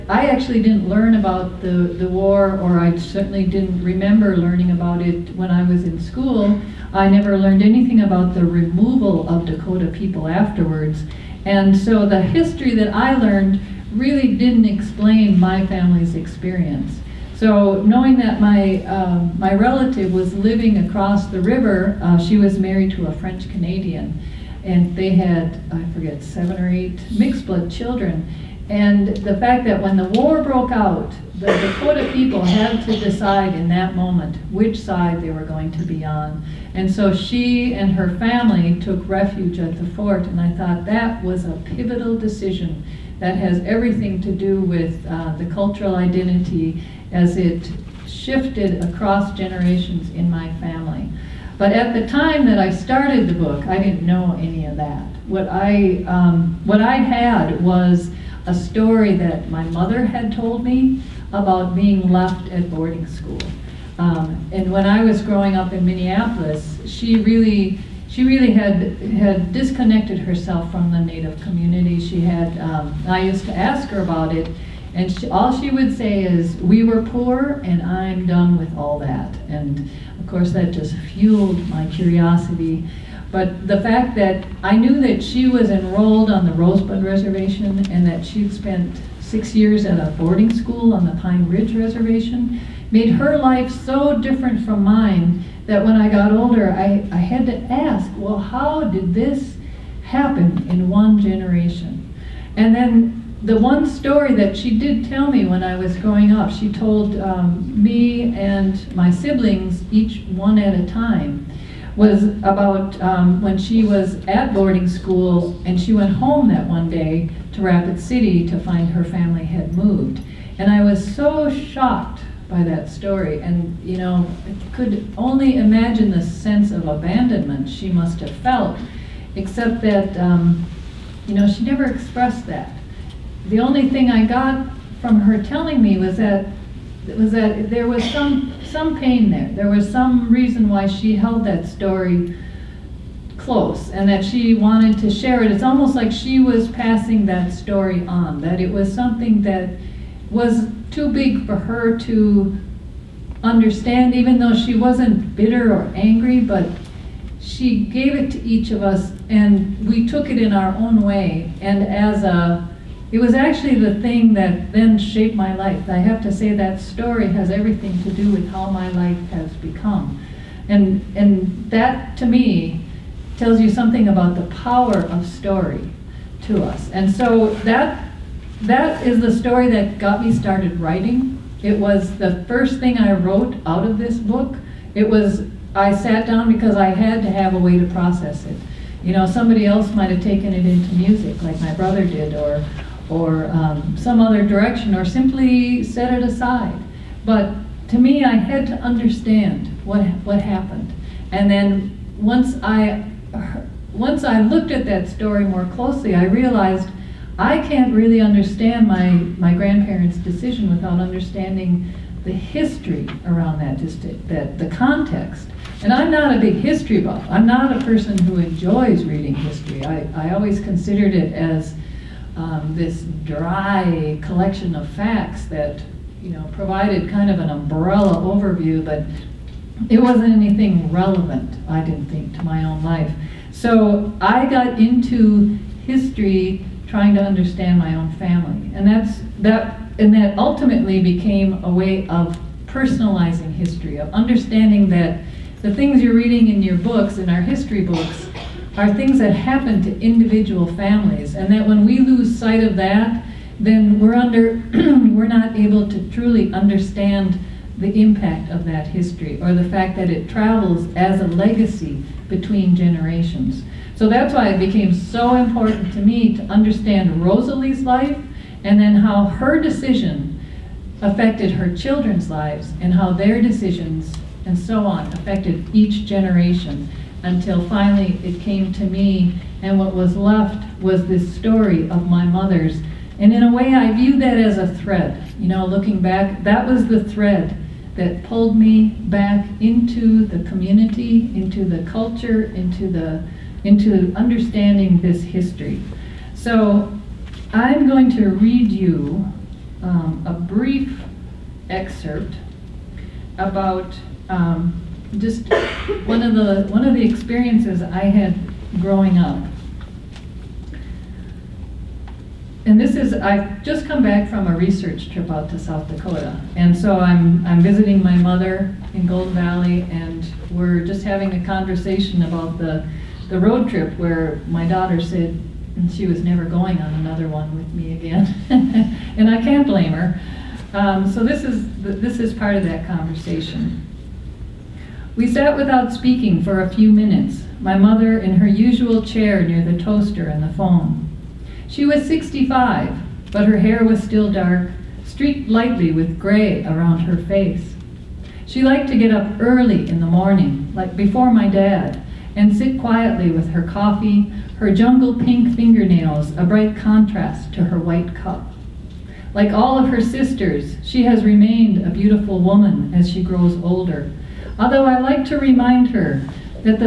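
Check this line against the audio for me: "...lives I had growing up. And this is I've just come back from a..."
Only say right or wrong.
wrong.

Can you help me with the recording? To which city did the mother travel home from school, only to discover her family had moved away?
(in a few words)
Rapid City.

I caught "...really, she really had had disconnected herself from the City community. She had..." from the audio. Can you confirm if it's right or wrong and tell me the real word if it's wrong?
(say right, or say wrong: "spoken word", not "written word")
wrong: "Native", not "City".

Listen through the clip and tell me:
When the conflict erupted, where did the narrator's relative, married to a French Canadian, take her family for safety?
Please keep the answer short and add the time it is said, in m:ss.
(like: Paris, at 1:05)
the fort, at 0:39.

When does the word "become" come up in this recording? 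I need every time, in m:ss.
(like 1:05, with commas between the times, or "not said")
2:49.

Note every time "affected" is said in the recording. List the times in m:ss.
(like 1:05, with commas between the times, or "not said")
4:31, 4:35.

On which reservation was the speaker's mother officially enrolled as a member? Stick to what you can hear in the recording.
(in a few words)
Rosebud Reservation.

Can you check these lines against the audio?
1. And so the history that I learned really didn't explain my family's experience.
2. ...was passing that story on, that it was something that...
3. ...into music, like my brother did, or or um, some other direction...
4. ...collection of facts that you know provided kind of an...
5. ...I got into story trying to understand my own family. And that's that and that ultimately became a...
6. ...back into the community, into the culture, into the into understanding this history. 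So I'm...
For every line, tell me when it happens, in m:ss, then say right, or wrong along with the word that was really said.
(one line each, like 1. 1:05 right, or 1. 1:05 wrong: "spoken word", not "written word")
1. 0:11 right
2. 2:26 right
3. 3:10 right
4. 3:44 right
5. 3:54 wrong: "history", not "story"
6. 4:49 right.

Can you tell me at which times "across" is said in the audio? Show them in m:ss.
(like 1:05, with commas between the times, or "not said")
0:20, 0:48.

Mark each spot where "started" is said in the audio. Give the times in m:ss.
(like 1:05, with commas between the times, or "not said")
0:52, 3:00.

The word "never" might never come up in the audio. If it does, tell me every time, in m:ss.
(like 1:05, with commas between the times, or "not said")
0:07, 2:11, 5:26.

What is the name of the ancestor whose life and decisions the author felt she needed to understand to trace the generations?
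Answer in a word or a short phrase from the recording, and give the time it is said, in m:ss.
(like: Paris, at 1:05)
Rosalie, at 4:27.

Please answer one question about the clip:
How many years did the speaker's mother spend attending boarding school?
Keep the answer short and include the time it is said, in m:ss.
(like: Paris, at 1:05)
6, at 1:29.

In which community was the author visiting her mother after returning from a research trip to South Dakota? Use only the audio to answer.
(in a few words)
Golden Valley.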